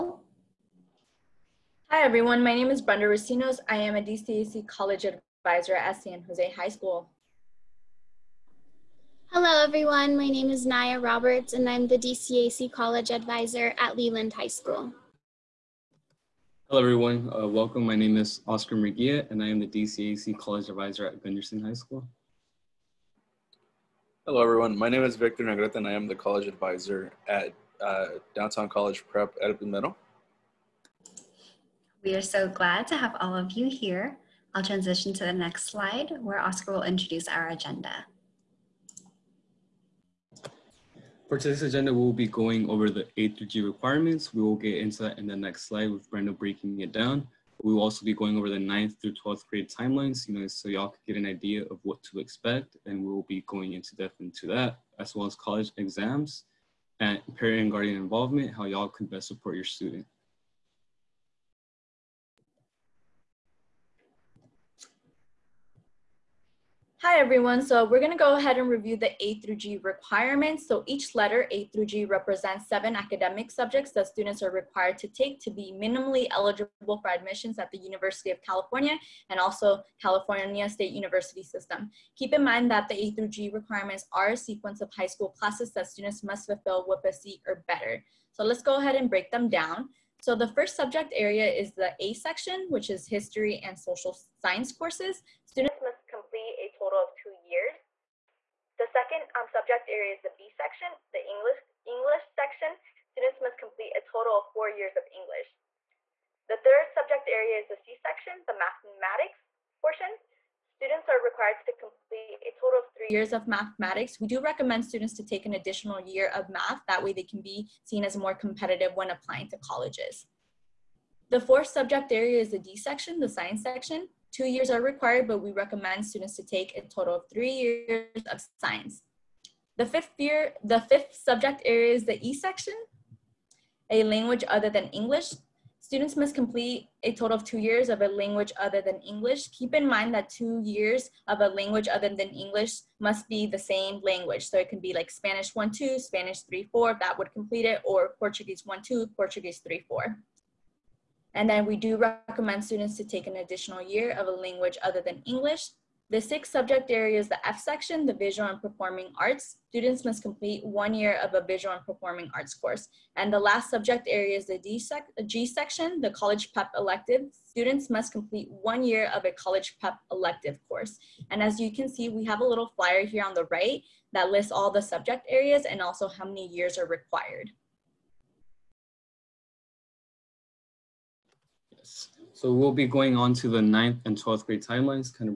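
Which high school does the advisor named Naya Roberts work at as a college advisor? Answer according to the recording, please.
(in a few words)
Leland High School.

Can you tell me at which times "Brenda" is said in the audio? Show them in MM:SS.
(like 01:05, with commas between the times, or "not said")
00:02, 00:46.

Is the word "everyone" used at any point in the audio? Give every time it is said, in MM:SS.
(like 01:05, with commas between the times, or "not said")
00:02, 00:09, 00:16, 00:24, 01:07.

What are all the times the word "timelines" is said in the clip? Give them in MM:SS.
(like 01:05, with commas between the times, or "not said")
00:49, 03:04.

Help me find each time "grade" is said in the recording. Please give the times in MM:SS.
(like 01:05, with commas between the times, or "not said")
00:49, 03:04.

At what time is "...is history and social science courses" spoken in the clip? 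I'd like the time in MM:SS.
01:32.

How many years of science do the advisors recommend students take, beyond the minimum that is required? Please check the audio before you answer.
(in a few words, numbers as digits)
3.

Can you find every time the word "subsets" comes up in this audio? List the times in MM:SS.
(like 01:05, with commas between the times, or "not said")
not said.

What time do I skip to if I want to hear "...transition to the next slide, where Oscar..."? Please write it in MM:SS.
00:34.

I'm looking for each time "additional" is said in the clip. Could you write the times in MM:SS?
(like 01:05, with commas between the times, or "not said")
01:55, 02:33.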